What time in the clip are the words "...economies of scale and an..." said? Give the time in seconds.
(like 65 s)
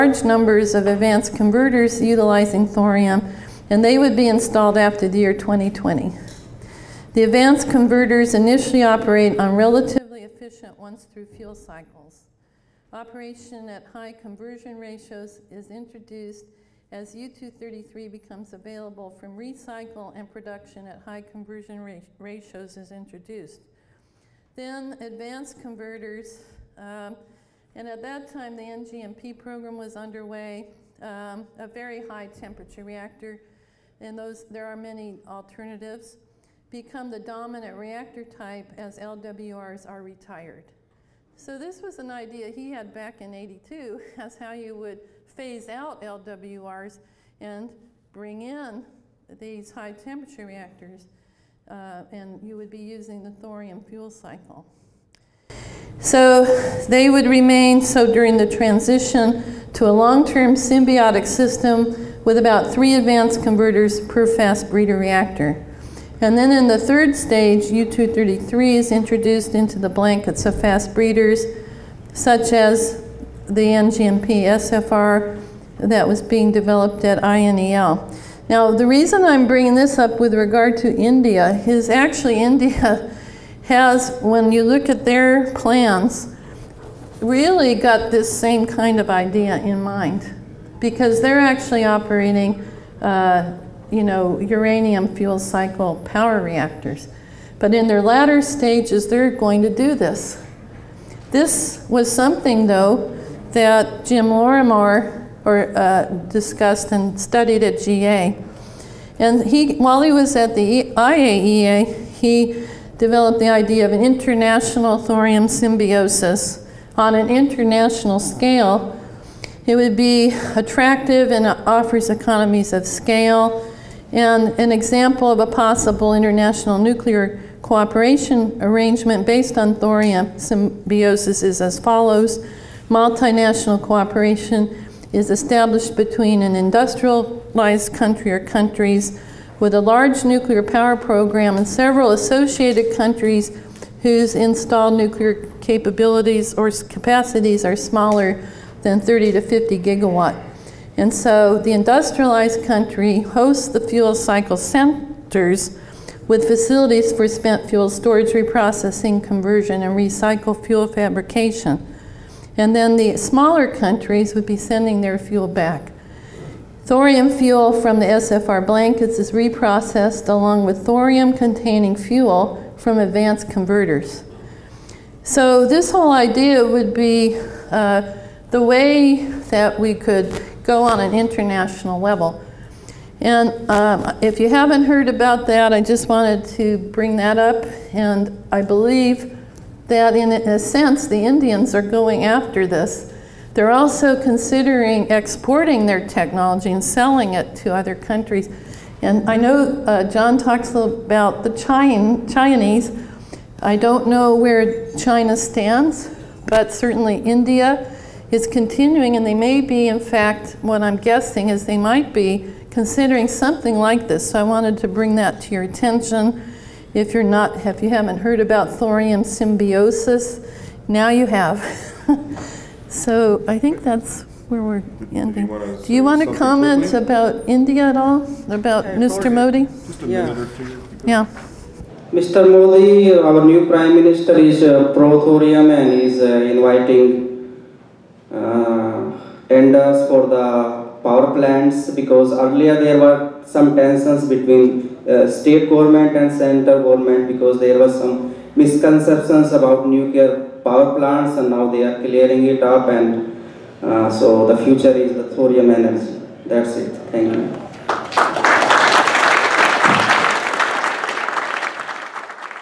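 122 s.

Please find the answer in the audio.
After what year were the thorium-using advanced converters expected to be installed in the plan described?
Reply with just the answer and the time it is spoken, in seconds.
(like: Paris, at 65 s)
2020, at 5 s.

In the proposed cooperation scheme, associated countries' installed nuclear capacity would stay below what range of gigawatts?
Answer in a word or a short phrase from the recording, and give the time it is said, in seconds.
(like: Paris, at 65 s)
30 to 50 gigawatts, at 149 s.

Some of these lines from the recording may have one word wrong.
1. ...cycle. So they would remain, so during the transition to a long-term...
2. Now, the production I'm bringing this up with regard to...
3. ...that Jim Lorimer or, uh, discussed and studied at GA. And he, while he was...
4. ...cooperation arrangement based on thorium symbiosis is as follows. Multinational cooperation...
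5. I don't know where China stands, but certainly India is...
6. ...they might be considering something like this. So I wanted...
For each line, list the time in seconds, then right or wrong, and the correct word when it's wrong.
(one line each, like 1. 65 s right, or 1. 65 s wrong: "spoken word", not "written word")
1. 54 s right
2. 78 s wrong: "reason", not "production"
3. 103 s right
4. 127 s right
5. 203 s right
6. 211 s right.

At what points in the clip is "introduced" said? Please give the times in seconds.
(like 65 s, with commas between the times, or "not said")
15 s, 22 s, 68 s.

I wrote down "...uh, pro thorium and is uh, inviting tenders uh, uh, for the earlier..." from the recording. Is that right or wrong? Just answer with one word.
wrong.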